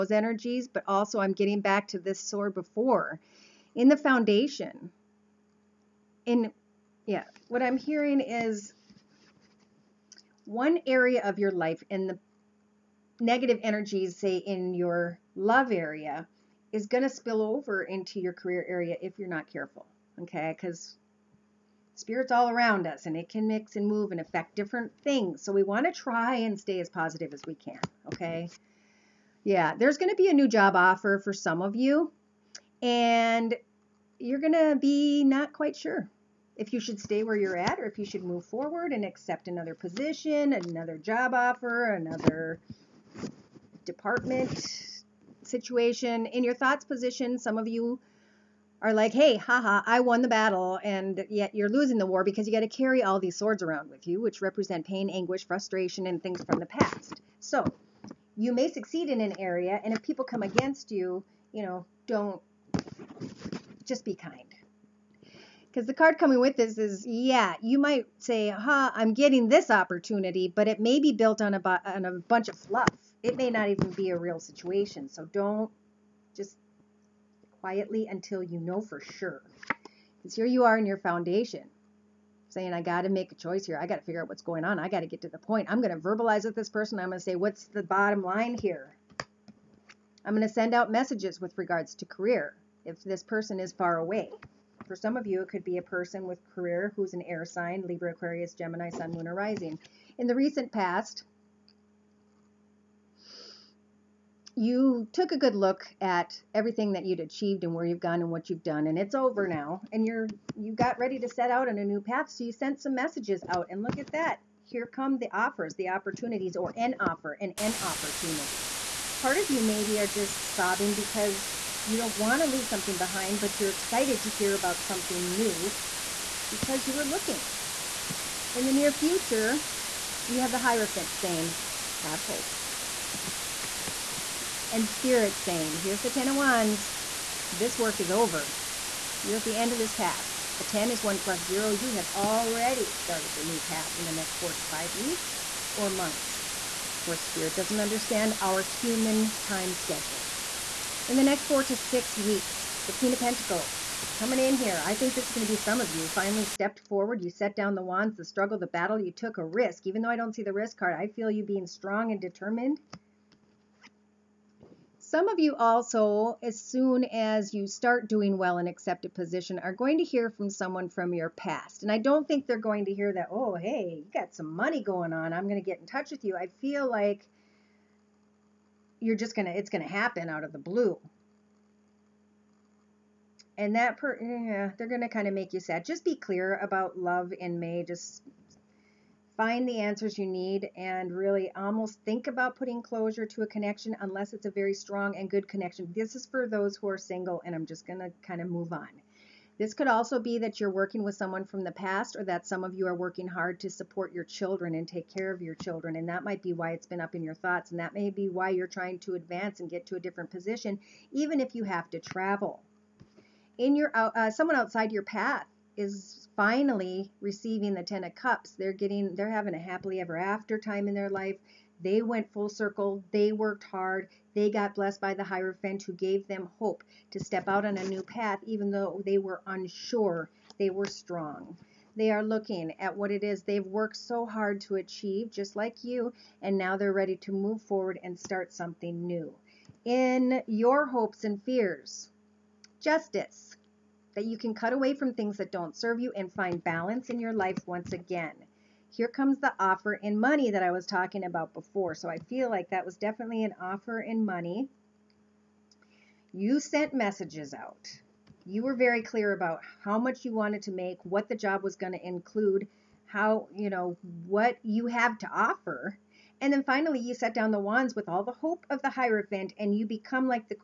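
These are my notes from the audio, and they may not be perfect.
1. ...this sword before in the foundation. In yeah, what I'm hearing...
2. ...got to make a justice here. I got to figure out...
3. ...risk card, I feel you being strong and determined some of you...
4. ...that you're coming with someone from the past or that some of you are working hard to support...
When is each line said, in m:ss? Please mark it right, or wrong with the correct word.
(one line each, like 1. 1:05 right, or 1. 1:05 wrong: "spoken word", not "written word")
1. 0:01 right
2. 1:22 wrong: "choice", not "justice"
3. 2:40 right
4. 3:20 wrong: "working", not "coming".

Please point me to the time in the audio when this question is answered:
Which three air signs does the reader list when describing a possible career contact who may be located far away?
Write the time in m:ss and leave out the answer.
1:37.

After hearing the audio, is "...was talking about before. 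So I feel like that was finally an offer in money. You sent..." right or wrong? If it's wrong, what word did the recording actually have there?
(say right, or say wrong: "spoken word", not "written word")
wrong: "definitely", not "finally".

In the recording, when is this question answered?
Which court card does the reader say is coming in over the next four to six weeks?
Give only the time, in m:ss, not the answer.
2:32.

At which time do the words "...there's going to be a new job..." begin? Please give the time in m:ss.
0:29.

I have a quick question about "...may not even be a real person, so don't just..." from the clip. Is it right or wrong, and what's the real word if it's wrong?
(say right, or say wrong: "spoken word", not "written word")
wrong: "situation", not "person".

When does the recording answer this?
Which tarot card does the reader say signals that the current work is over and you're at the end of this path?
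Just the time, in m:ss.
2:16.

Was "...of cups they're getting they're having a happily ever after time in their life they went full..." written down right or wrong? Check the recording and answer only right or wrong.
right.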